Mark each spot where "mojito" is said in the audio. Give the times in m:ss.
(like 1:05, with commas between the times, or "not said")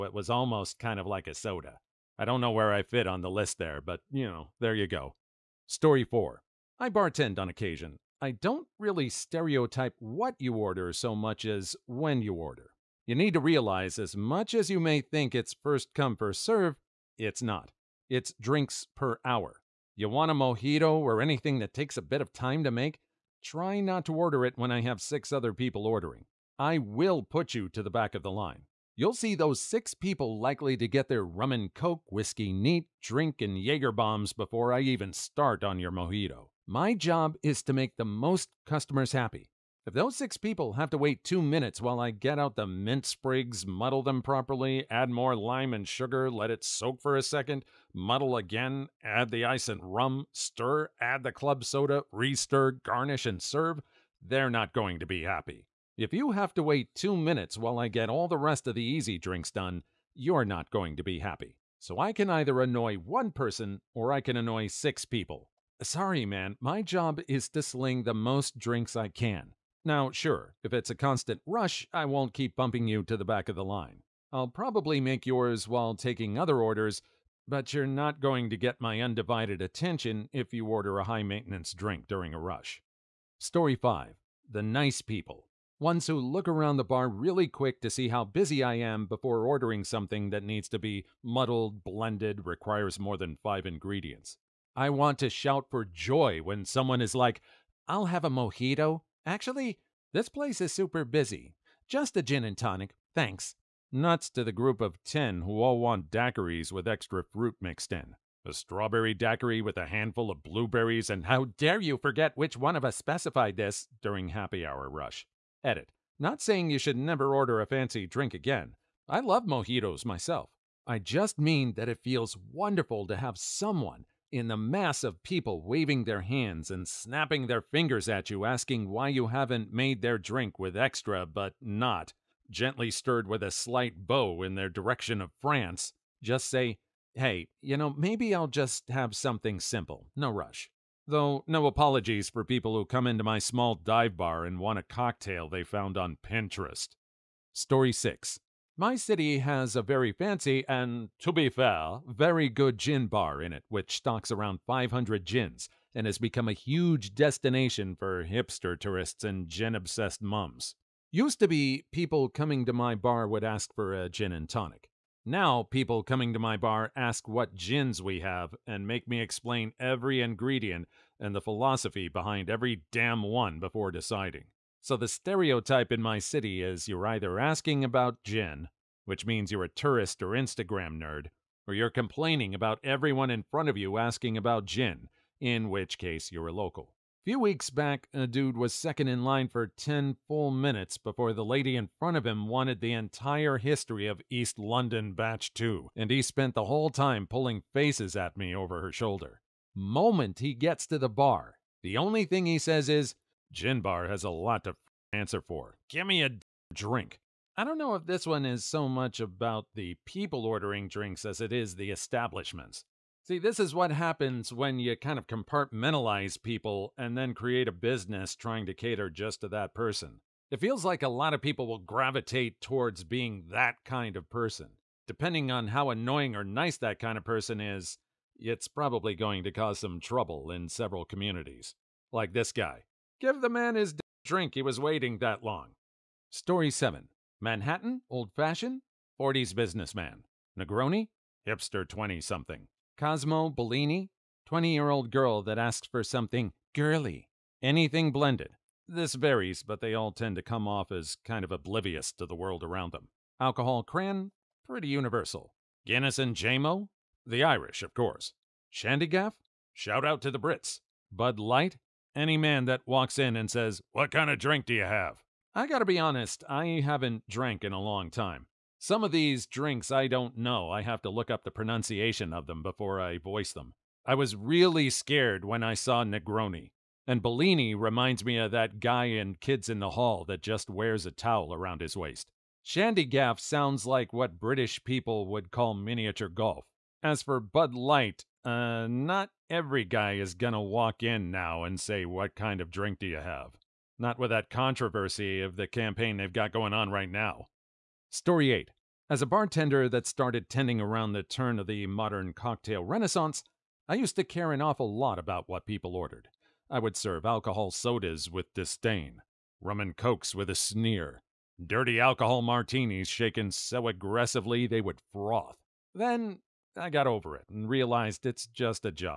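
0:20, 0:35, 1:38, 1:59.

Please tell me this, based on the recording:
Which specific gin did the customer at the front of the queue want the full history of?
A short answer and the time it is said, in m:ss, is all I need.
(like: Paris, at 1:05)
East London Batch 2, at 3:14.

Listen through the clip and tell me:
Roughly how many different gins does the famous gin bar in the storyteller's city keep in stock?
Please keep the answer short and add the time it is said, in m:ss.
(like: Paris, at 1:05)
500, at 2:34.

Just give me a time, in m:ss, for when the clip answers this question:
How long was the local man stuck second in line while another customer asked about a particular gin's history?
3:09.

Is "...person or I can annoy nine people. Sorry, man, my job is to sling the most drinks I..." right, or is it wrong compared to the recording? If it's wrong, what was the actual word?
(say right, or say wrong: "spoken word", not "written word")
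wrong: "six", not "nine".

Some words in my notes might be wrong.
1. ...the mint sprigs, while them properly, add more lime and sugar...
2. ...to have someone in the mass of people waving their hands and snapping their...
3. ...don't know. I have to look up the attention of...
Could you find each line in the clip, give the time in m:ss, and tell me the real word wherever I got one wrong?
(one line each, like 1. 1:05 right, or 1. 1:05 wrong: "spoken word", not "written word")
1. 0:42 wrong: "muddle", not "while"
2. 2:03 right
3. 4:30 wrong: "pronunciation", not "attention".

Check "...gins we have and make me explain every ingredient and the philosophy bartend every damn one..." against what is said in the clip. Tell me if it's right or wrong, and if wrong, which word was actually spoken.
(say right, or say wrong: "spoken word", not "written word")
wrong: "behind", not "bartend".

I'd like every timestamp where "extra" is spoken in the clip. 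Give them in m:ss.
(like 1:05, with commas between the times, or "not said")
1:46, 2:10.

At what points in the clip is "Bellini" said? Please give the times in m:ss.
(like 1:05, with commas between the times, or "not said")
4:03, 4:37.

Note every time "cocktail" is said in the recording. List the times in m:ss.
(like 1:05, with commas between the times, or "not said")
2:24, 5:02.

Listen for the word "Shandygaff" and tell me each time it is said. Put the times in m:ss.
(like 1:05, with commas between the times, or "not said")
4:18, 4:42.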